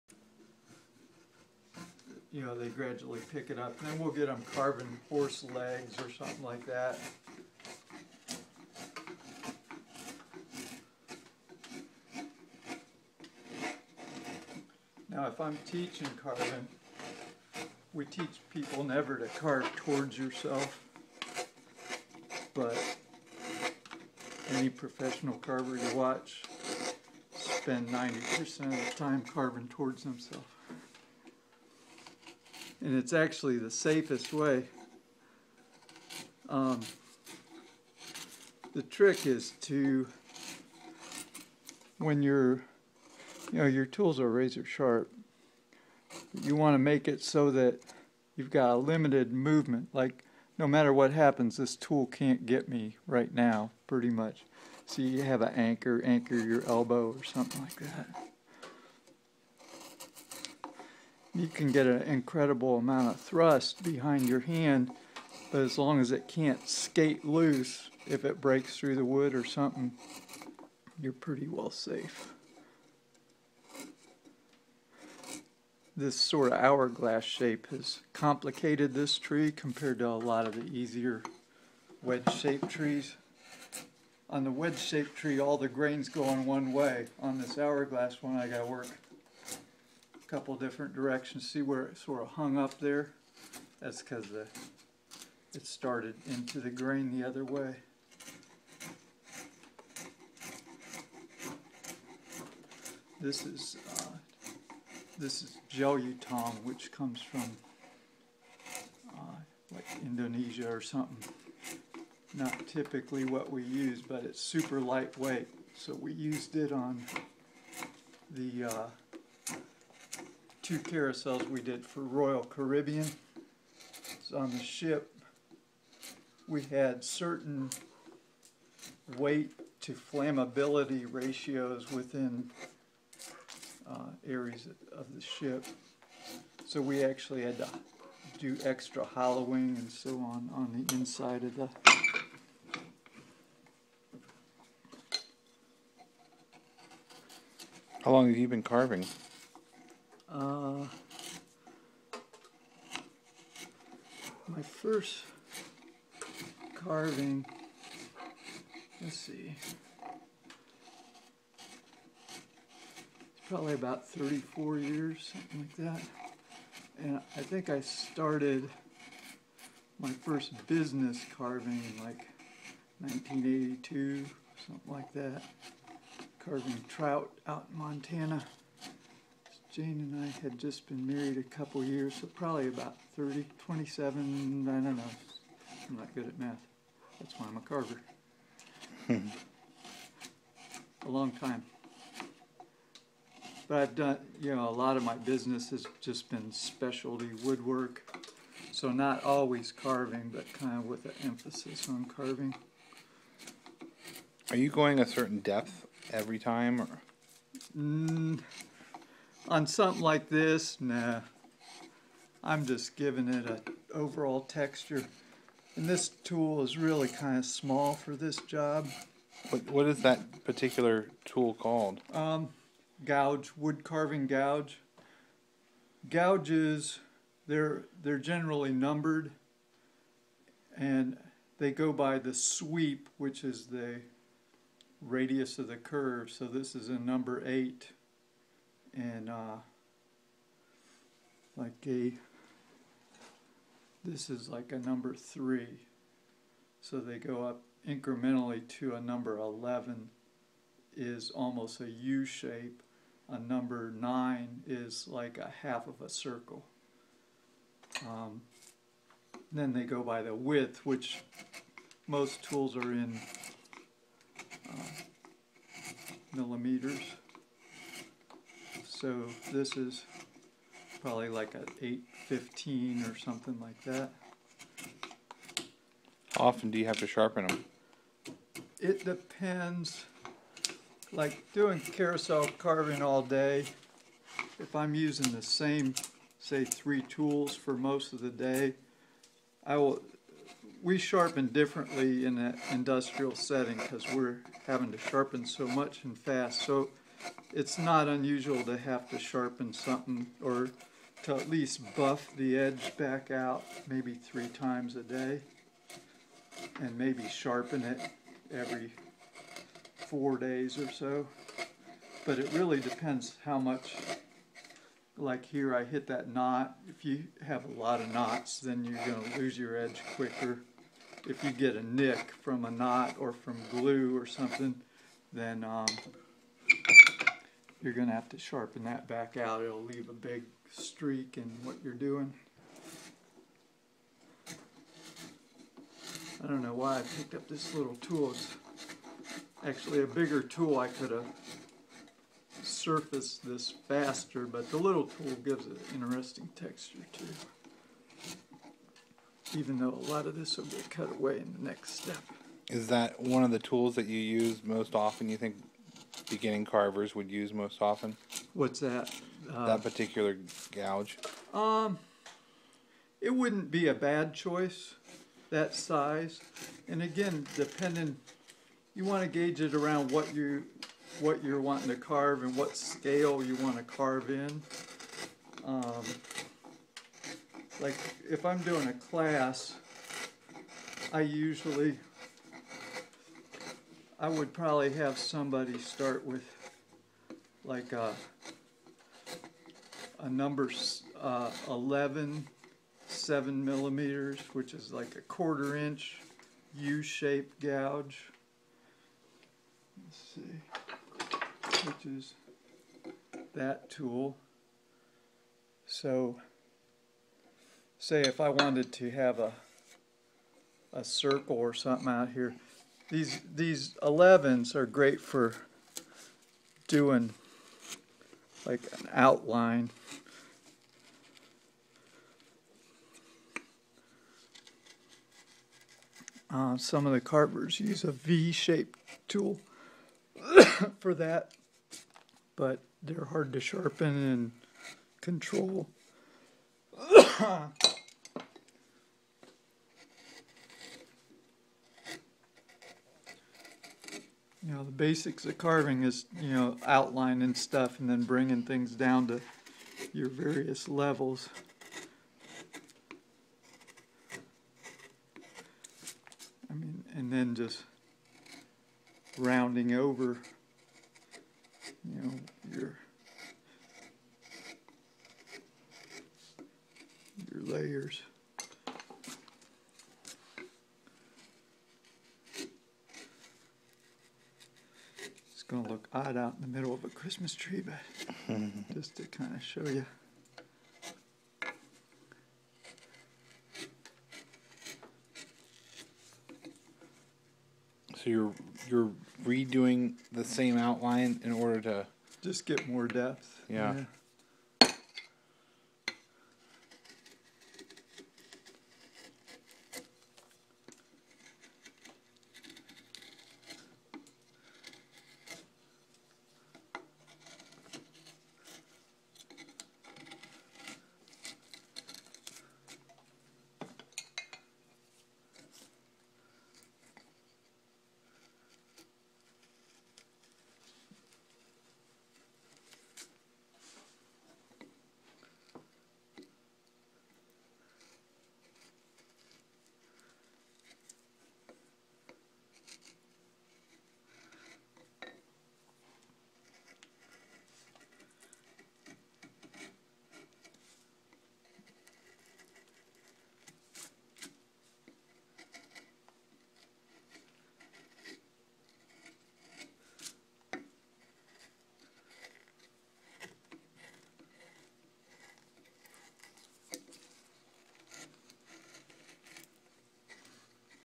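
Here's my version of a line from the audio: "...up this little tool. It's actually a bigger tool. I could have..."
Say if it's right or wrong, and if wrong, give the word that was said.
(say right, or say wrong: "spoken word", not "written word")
right.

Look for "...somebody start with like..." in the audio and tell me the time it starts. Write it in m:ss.
6:25.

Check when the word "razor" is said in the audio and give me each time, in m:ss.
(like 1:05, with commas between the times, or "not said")
0:44.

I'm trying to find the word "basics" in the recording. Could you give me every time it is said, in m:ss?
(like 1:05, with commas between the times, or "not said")
7:24.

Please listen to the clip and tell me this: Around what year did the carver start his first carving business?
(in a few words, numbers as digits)
1982.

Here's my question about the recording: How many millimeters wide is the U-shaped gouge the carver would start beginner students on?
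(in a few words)
7 millimeters.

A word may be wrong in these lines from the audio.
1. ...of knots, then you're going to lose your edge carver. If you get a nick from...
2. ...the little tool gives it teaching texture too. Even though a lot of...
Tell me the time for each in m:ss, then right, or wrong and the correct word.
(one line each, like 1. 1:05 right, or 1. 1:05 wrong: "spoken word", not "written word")
1. 5:17 wrong: "quicker", not "carver"
2. 5:44 wrong: "interesting", not "teaching".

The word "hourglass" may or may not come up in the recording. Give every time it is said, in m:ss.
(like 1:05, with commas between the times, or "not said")
1:16, 1:27.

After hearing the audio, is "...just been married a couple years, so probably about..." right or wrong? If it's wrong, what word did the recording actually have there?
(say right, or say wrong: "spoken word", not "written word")
right.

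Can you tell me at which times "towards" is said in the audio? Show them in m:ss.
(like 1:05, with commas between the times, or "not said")
0:19, 0:29.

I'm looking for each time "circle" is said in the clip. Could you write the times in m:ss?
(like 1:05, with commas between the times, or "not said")
4:16, 6:51.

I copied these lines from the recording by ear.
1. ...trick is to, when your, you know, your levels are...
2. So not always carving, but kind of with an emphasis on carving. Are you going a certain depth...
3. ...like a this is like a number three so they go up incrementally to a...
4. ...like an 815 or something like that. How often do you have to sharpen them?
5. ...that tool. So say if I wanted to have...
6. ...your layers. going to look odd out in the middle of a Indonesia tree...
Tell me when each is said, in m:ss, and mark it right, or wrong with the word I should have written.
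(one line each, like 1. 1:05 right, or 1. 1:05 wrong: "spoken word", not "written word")
1. 0:38 wrong: "tools", not "levels"
2. 3:18 right
3. 4:01 right
4. 4:31 right
5. 6:43 right
6. 7:47 wrong: "Christmas", not "Indonesia".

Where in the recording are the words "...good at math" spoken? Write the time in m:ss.
3:06.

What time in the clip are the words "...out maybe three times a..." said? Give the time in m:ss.
5:03.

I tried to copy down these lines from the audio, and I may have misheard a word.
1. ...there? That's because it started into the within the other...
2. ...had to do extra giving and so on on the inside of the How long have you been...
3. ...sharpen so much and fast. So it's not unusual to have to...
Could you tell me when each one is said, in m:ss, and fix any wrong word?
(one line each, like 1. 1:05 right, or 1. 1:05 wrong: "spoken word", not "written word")
1. 1:32 wrong: "grain", not "within"
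2. 2:17 wrong: "hollowing", not "giving"
3. 4:54 right.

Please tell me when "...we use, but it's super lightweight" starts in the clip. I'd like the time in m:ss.
1:53.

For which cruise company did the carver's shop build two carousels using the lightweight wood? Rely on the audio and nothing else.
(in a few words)
Royal Caribbean.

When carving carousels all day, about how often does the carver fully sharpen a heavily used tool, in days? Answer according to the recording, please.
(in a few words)
every 4 days.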